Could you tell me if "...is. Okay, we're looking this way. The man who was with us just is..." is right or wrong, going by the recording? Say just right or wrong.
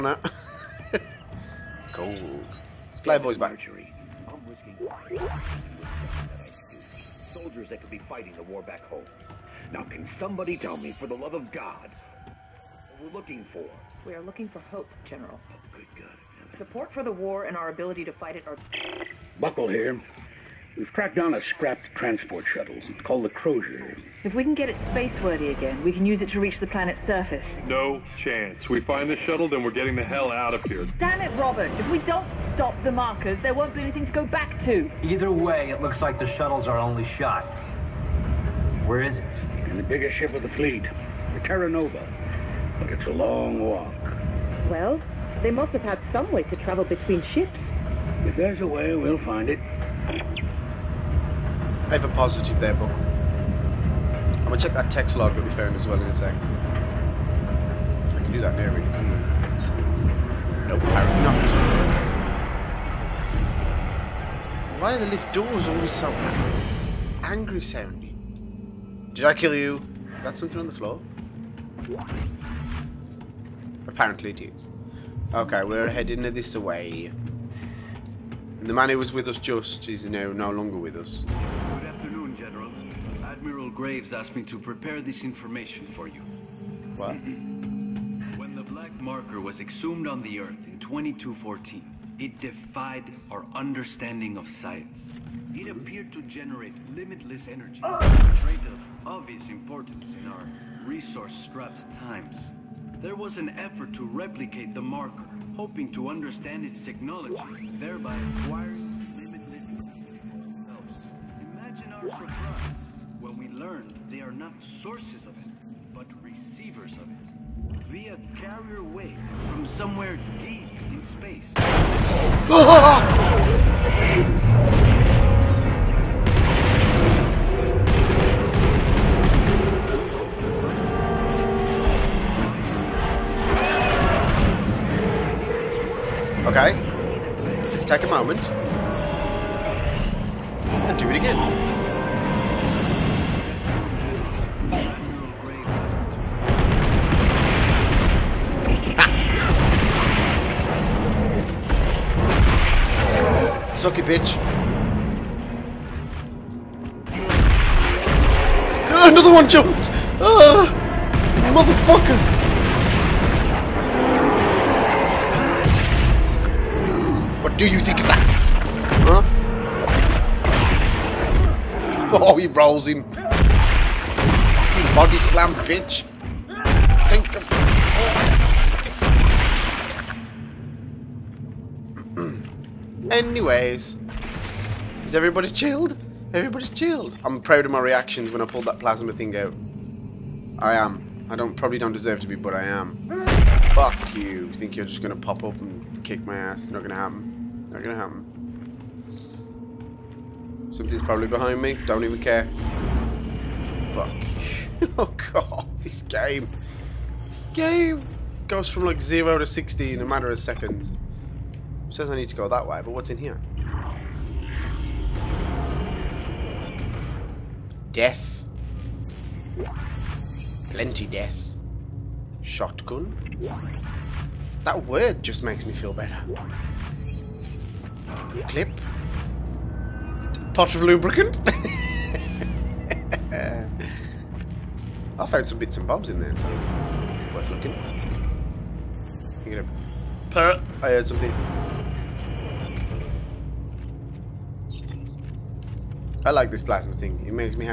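wrong.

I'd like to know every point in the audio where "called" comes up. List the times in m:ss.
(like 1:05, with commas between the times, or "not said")
0:23.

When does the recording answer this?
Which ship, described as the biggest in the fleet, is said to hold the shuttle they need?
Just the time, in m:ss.
0:41.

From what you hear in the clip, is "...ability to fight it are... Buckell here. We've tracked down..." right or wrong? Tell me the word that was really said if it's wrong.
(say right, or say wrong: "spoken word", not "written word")
right.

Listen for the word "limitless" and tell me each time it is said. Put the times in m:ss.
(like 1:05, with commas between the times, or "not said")
1:36, 1:49.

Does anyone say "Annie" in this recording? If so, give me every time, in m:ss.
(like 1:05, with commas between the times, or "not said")
not said.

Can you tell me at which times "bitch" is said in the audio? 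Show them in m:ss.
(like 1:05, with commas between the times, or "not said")
2:34, 2:55.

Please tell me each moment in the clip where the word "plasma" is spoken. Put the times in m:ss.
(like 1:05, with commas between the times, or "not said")
3:08, 4:06.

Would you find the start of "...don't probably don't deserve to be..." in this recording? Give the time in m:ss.
3:11.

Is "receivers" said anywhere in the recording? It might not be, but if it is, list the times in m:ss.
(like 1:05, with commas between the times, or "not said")
1:56.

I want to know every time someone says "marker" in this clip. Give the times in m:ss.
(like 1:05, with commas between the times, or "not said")
0:32, 1:28, 1:44.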